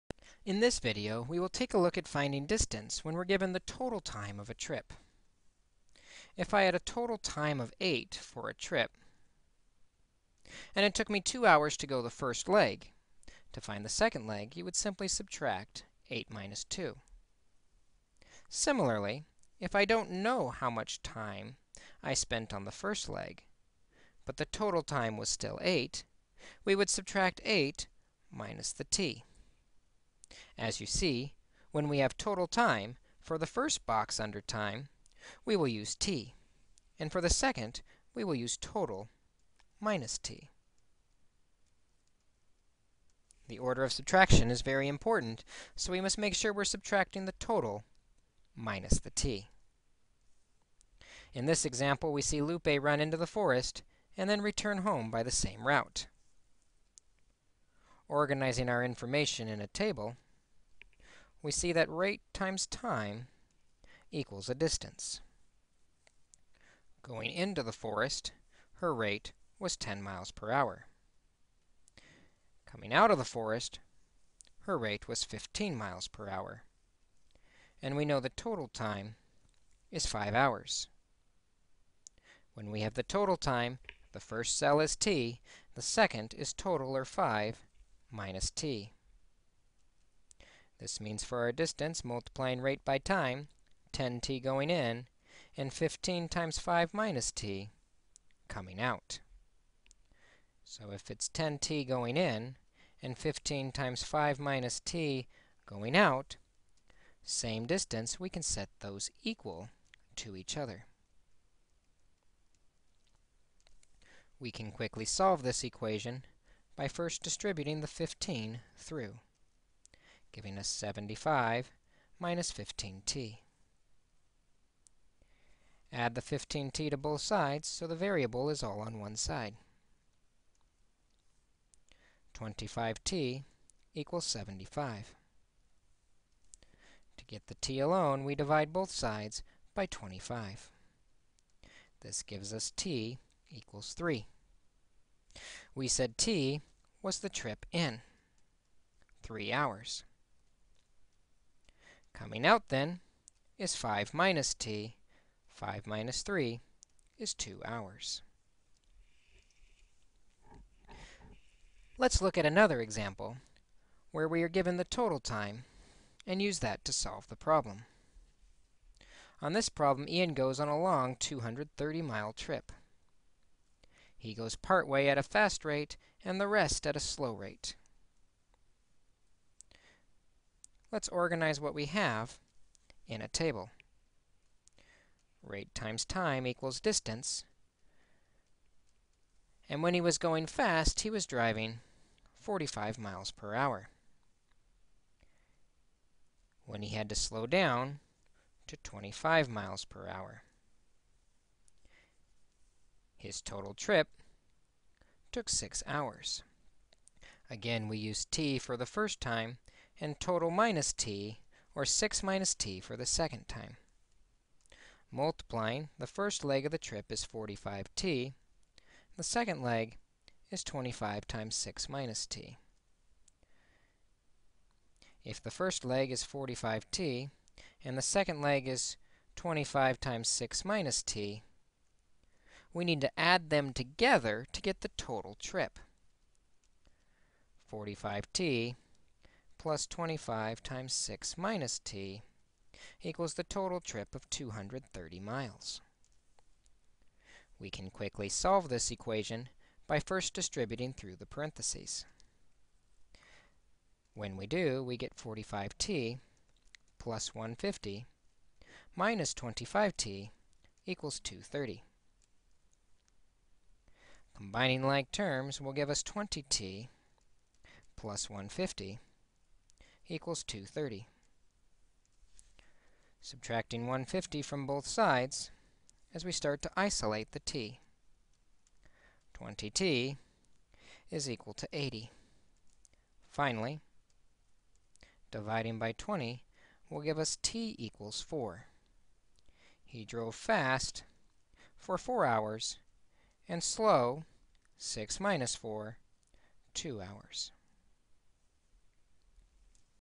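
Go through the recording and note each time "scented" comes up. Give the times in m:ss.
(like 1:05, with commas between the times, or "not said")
not said.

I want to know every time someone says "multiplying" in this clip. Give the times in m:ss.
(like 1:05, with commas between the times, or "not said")
1:32, 3:35.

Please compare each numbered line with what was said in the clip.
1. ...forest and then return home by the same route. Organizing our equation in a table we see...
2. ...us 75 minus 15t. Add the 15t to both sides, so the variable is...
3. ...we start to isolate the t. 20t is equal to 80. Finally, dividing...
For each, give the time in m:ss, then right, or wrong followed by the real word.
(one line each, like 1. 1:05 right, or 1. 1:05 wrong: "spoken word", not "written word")
1. 0:53 wrong: "information", not "equation"
2. 2:00 right
3. 4:36 right.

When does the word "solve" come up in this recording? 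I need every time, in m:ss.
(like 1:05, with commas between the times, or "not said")
1:55, 2:46, 4:08.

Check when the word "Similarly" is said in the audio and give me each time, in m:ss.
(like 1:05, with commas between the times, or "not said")
0:18.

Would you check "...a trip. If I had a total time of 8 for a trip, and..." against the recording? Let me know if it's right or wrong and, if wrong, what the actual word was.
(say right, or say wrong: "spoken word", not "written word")
right.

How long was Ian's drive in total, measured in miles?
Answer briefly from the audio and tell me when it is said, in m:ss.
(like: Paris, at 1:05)
230 miles, at 2:51.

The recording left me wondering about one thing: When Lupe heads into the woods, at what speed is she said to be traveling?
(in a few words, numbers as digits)
10 miles per hour.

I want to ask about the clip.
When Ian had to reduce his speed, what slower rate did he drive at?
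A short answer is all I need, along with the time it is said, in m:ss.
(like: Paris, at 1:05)
25 miles per hour, at 3:18.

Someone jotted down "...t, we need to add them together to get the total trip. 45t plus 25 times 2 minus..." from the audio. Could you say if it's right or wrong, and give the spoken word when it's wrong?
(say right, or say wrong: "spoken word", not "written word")
wrong: "6", not "2".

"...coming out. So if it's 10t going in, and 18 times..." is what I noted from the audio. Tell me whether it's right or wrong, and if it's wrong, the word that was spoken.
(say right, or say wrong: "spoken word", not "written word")
wrong: "15", not "18".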